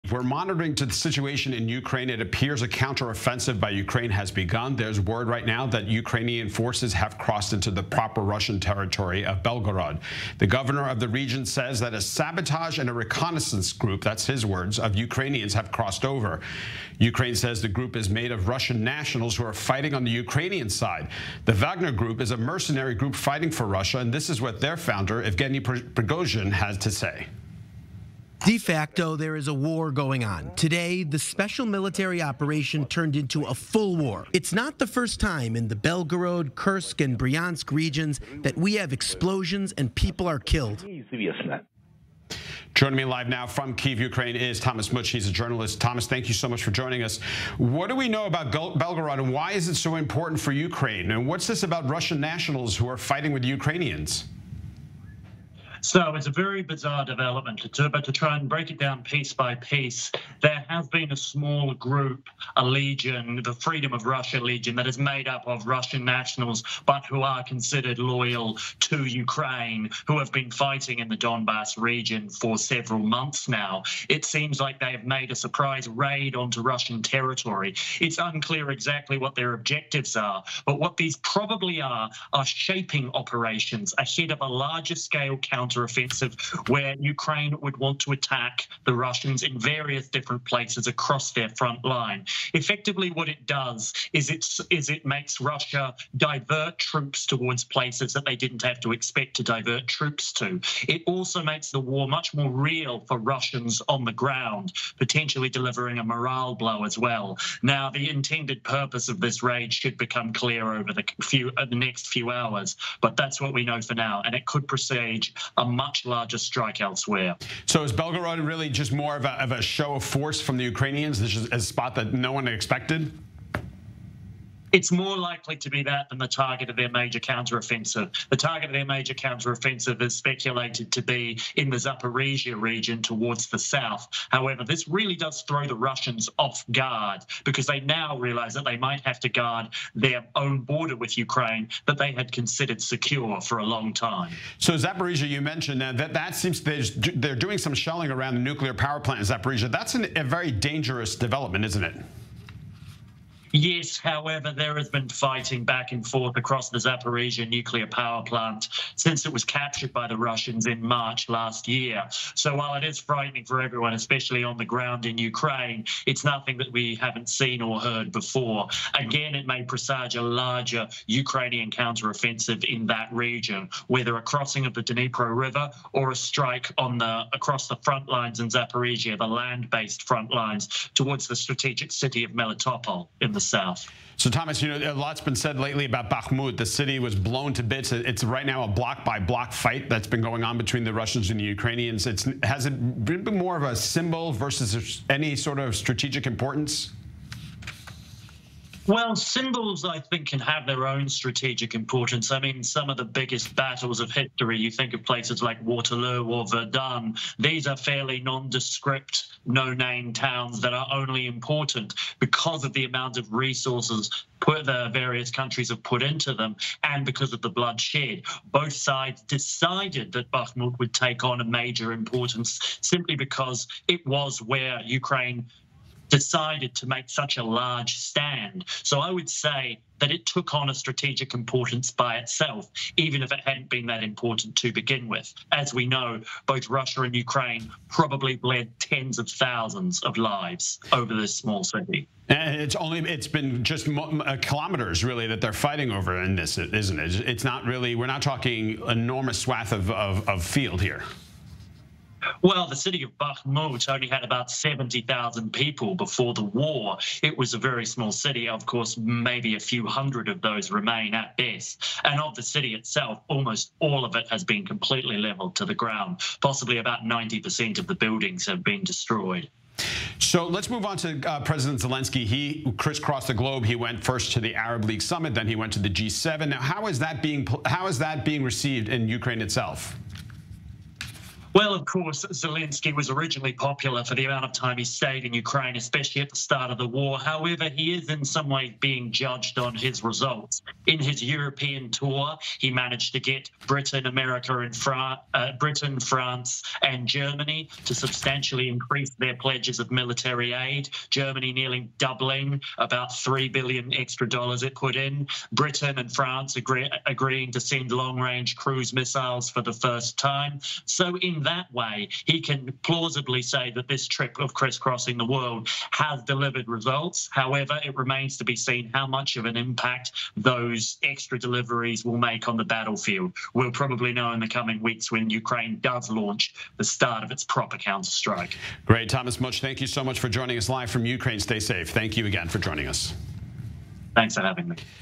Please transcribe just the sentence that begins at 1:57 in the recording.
So is Belgorod really just more of a, of a show of force from the Ukrainians?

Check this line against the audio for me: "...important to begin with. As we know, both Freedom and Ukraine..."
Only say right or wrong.
wrong.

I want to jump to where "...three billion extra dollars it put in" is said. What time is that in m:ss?
5:03.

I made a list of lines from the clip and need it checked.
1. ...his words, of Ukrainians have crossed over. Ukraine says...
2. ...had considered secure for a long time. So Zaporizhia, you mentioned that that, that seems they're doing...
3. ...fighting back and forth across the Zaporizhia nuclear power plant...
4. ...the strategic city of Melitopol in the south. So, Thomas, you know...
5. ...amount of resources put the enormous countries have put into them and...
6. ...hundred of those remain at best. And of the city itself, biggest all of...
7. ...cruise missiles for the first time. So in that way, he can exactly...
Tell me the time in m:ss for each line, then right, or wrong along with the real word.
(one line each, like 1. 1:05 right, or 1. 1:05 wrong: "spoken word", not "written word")
1. 0:14 right
2. 2:22 right
3. 2:35 right
4. 3:01 right
5. 3:32 wrong: "various", not "enormous"
6. 4:19 wrong: "almost", not "biggest"
7. 5:08 wrong: "plausibly", not "exactly".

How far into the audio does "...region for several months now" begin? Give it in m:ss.
1:11.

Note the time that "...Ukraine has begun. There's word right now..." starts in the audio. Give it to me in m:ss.
0:03.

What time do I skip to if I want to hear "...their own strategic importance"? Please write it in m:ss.
3:20.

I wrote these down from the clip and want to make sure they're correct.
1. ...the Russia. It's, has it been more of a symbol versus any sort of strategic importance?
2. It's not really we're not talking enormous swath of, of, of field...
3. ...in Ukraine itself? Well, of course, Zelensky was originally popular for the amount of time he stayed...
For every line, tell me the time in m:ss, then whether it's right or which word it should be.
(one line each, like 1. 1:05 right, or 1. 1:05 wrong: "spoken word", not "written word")
1. 3:11 wrong: "Ukrainians", not "Russia"
2. 4:07 right
3. 4:38 right.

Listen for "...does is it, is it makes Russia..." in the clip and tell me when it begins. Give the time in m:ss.
1:33.